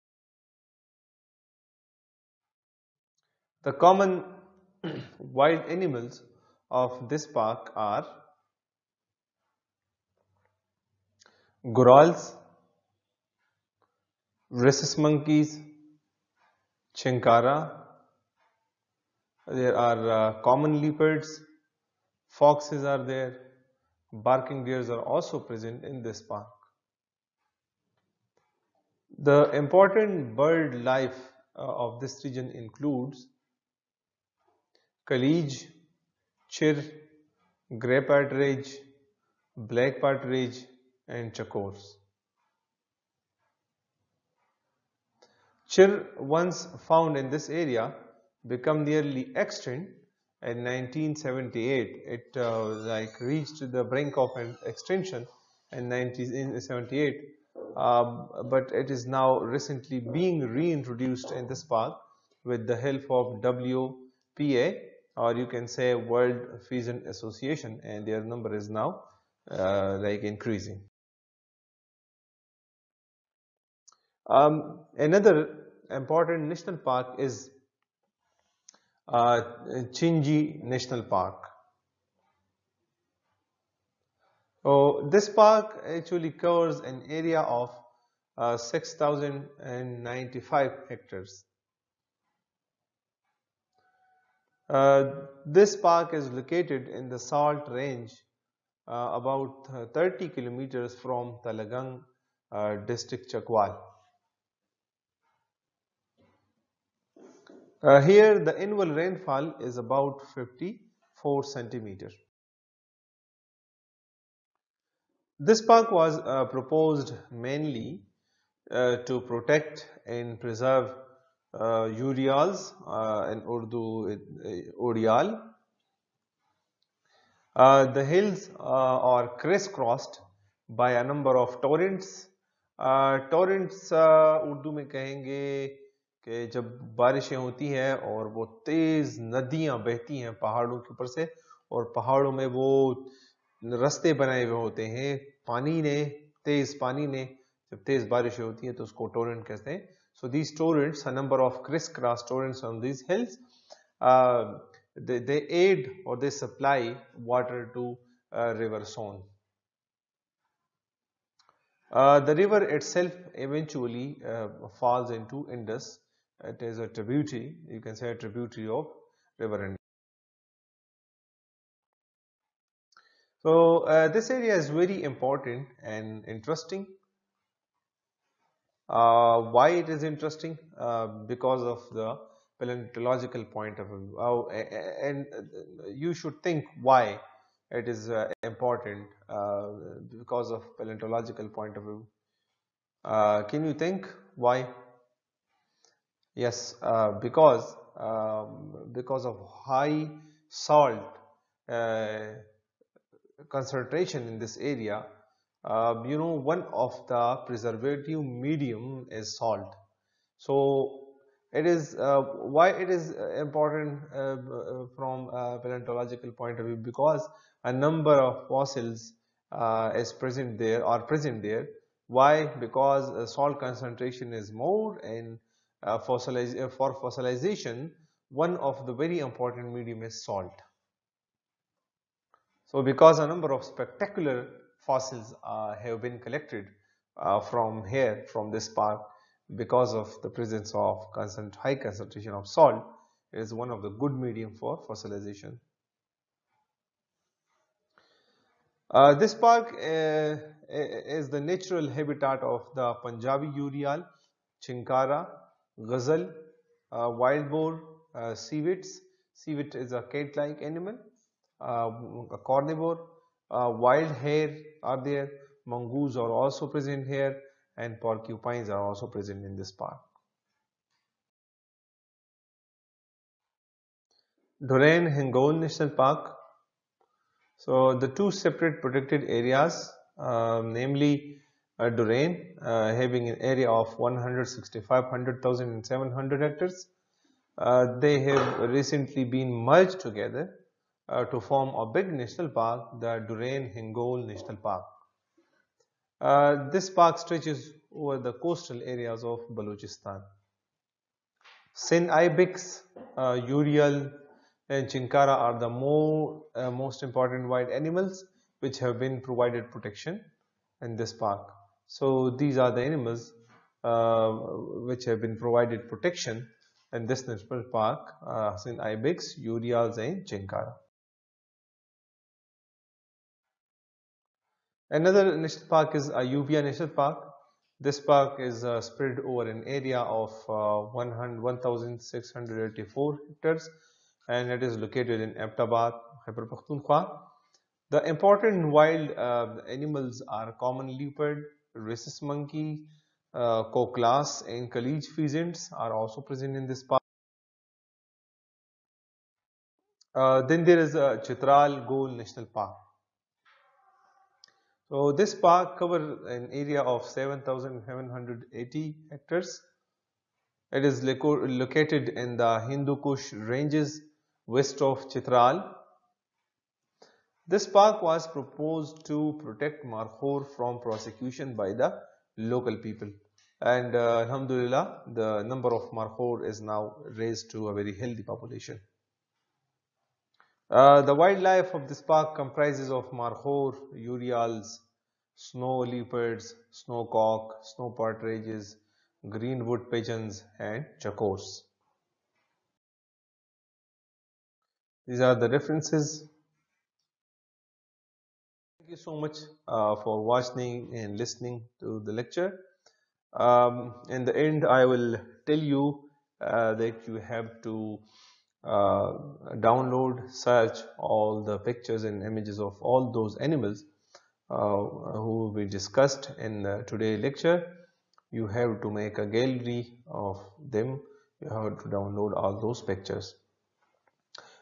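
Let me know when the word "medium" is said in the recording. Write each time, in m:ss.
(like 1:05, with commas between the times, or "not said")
3:28, 3:49, 4:04.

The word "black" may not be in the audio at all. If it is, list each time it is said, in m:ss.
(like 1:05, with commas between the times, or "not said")
0:39.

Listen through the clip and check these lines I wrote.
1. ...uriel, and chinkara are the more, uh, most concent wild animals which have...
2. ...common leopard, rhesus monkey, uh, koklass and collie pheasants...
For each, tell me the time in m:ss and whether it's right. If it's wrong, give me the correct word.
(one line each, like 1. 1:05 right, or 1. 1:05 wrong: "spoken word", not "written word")
1. 5:03 wrong: "important", not "concent"
2. 5:40 right.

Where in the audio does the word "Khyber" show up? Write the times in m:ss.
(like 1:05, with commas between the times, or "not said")
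5:36.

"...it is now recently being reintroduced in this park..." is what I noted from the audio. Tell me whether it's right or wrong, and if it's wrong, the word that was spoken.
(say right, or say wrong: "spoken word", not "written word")
right.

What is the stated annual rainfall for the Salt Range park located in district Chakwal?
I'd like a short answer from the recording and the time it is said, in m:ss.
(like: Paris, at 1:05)
54 centimeters, at 1:50.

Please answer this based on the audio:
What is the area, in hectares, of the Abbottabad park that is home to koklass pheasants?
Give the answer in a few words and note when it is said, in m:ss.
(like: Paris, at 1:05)
1,684 hectares, at 5:30.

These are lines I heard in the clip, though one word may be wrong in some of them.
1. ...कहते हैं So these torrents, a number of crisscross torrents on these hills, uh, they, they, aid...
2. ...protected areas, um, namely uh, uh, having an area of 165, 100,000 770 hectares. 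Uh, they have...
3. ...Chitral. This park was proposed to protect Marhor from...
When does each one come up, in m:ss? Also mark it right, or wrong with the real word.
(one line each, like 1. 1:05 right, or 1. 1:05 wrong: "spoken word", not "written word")
1. 2:29 right
2. 4:38 wrong: "700", not "770"
3. 6:05 right.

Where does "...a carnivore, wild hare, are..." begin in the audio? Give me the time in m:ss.
4:22.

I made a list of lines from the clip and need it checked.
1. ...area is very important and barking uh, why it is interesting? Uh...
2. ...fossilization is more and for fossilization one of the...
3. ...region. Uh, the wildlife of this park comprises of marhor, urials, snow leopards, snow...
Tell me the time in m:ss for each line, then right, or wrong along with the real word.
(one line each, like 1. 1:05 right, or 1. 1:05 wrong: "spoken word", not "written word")
1. 2:54 wrong: "interesting", not "barking"
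2. 3:43 wrong: "concentration", not "fossilization"
3. 6:18 wrong: "population", not "region".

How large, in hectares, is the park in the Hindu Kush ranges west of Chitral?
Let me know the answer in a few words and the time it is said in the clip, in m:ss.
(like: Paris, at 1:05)
7,780 hectares, at 5:57.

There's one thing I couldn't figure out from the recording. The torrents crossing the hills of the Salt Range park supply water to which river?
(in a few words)
River Soan.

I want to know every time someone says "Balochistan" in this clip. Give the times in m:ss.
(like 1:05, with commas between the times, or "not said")
4:59.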